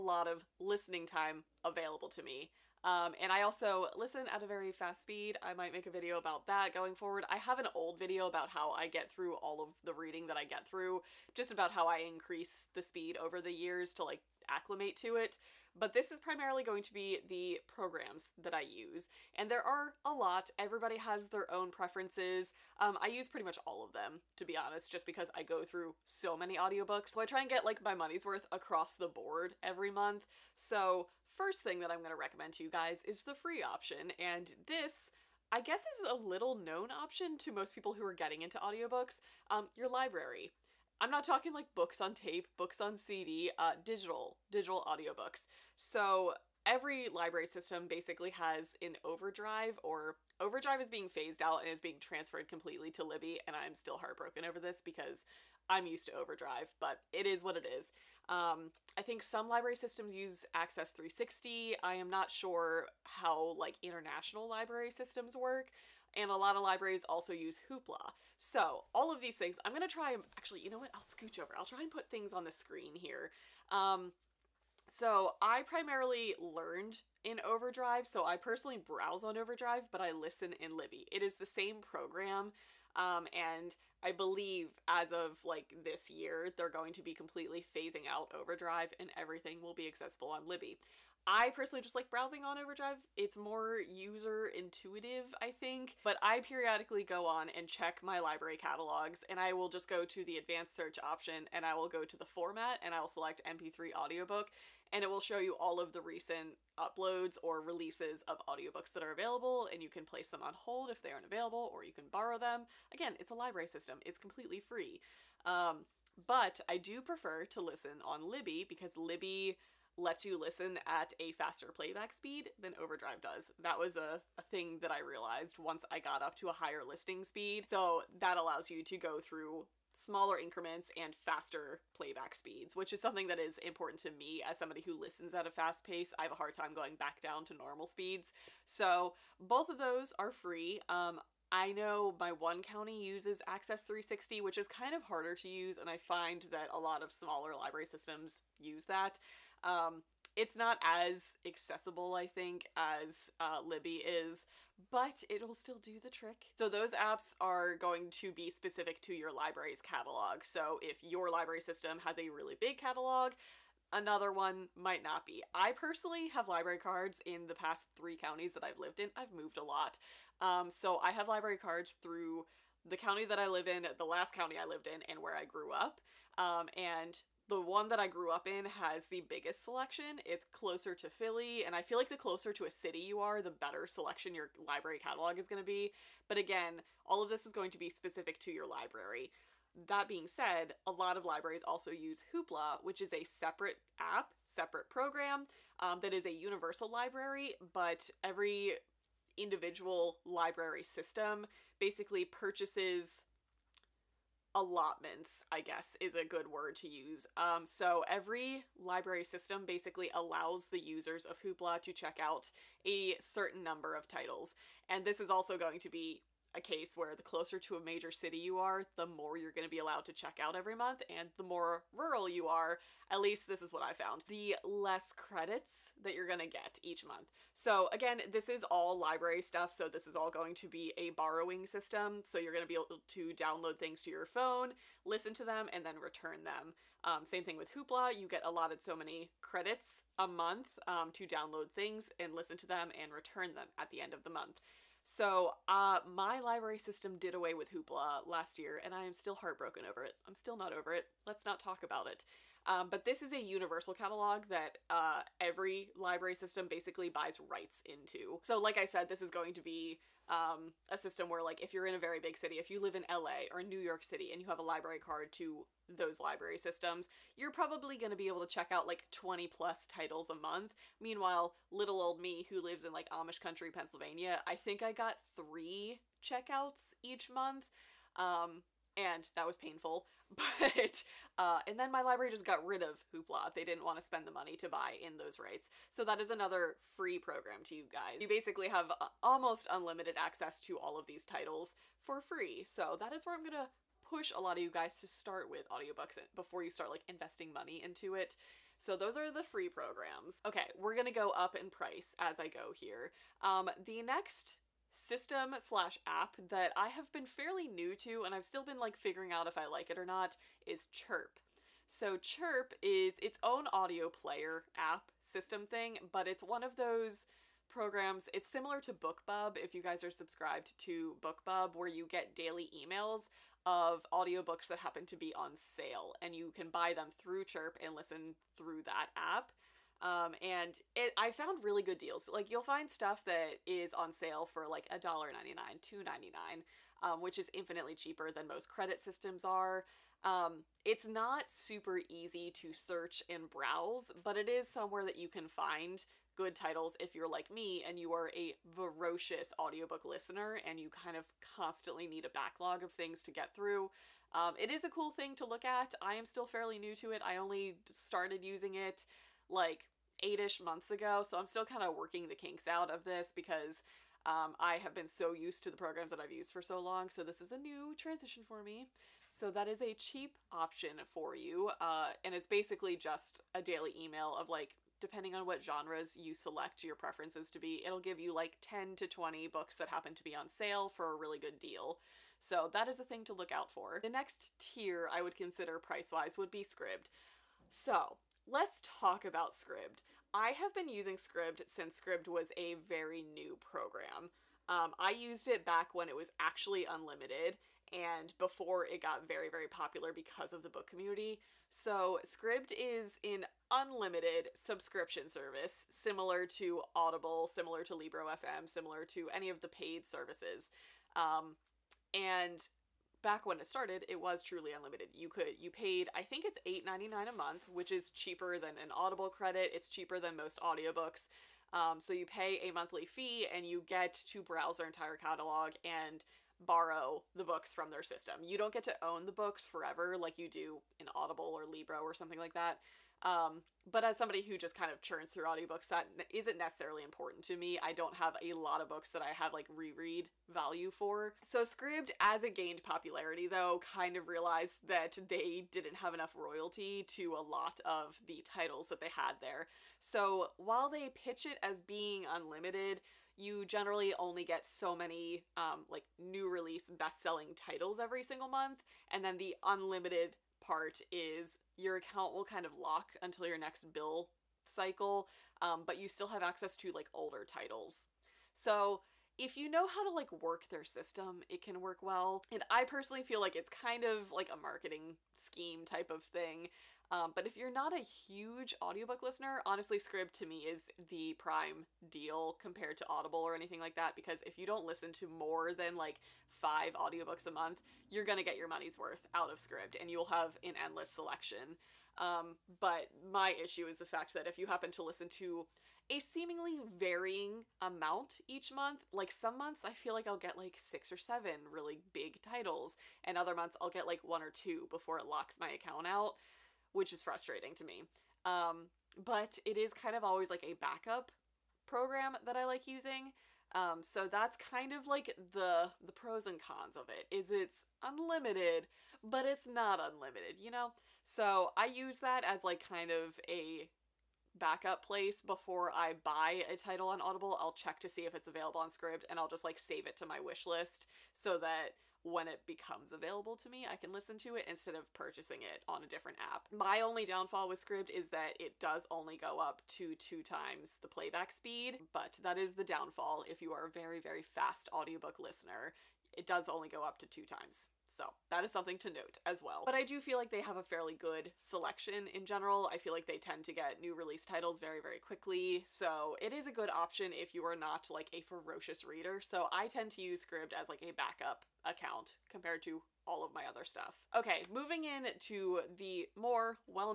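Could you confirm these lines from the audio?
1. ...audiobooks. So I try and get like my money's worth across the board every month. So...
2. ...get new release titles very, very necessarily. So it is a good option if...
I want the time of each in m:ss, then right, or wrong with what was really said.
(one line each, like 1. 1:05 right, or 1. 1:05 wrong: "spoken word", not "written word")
1. 0:26 right
2. 9:13 wrong: "quickly", not "necessarily".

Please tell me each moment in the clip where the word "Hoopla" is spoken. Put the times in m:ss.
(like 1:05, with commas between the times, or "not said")
1:07, 3:12, 3:31, 3:57, 4:07, 4:43.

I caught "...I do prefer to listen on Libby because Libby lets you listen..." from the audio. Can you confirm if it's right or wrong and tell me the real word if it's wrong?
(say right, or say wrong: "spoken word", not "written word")
right.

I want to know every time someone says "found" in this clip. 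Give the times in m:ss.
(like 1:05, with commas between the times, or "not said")
3:43, 5:31.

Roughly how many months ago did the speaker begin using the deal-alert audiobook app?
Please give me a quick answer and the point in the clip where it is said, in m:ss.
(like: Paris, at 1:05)
8, at 6:00.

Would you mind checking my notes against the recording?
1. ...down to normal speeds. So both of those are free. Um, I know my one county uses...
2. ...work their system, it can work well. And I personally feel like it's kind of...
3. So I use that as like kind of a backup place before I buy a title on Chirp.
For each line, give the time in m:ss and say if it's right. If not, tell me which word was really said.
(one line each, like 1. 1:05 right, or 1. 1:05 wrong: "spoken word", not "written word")
1. 2:17 right
2. 7:50 right
3. 8:41 wrong: "Audible", not "Chirp".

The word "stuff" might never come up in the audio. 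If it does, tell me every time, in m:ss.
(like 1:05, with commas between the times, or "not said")
3:49, 5:32, 9:23.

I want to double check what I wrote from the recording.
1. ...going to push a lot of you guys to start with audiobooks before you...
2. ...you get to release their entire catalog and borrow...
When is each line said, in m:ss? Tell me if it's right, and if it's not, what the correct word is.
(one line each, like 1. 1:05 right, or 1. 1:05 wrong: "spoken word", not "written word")
1. 4:53 right
2. 7:03 wrong: "browse", not "release".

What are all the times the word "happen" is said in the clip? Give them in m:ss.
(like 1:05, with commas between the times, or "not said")
5:24, 6:19, 8:14.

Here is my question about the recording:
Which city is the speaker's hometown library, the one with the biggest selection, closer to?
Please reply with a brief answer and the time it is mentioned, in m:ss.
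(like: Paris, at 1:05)
Philly, at 3:01.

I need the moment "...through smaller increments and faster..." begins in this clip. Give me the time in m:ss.
2:09.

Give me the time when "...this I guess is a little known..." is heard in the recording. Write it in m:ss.
0:34.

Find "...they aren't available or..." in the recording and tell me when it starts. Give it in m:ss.
1:51.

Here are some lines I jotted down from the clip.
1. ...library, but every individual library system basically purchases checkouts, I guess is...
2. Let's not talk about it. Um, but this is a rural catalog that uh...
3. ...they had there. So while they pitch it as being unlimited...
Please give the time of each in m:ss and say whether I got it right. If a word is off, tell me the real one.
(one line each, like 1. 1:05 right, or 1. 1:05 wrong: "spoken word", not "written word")
1. 3:16 wrong: "allotments", not "checkouts"
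2. 4:11 wrong: "universal", not "rural"
3. 7:28 right.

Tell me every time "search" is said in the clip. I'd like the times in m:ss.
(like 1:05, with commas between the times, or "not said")
1:40, 5:42.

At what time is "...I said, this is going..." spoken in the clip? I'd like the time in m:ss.
4:18.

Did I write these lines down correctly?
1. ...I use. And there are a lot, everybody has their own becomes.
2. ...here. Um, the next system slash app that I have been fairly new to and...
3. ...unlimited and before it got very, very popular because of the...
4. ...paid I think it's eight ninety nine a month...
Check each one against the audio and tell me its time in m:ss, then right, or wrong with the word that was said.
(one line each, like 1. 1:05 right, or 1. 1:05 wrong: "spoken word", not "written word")
1. 0:18 wrong: "preferences", not "becomes"
2. 5:02 right
3. 6:36 right
4. 6:55 right.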